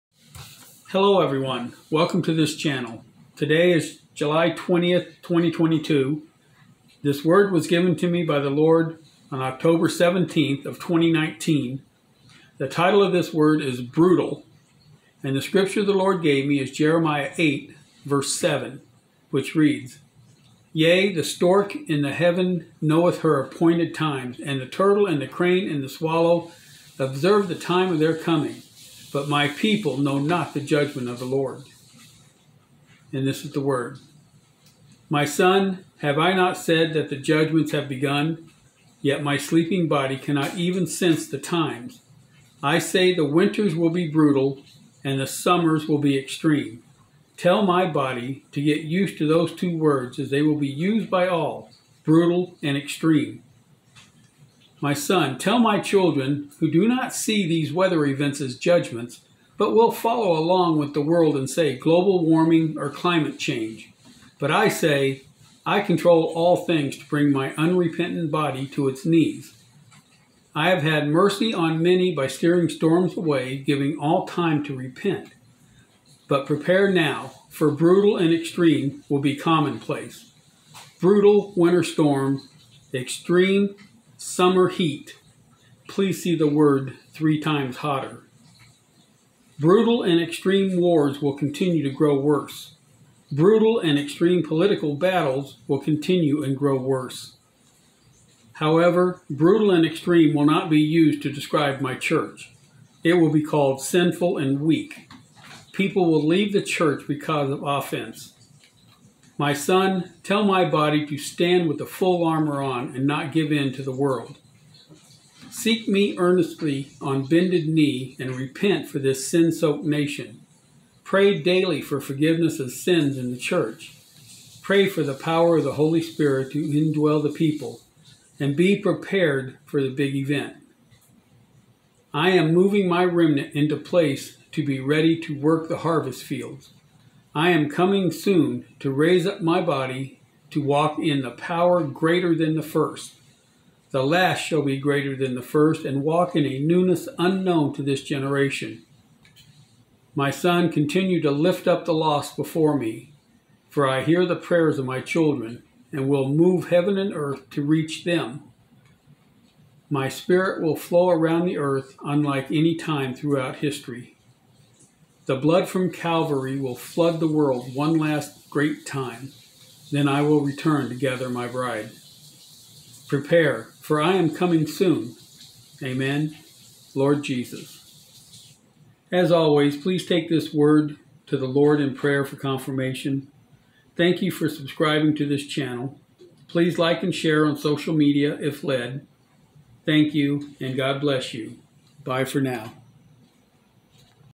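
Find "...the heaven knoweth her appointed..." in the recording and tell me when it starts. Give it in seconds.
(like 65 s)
22 s.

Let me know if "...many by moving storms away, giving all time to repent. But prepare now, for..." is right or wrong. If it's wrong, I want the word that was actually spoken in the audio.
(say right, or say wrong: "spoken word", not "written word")
wrong: "steering", not "moving".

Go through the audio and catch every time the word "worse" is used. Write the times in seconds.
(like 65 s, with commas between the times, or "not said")
92 s, 96 s.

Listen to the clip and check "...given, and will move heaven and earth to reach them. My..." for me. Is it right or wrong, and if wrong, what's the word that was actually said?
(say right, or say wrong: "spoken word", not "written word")
wrong: "children", not "given".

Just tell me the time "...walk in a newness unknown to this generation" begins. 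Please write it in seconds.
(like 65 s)
146 s.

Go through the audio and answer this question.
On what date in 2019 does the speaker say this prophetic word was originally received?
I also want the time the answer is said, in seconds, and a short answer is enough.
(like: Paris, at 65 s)
October 17, at 9 s.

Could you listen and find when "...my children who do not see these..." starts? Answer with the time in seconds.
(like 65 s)
55 s.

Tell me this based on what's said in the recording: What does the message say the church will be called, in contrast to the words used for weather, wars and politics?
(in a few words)
Sinful and weak.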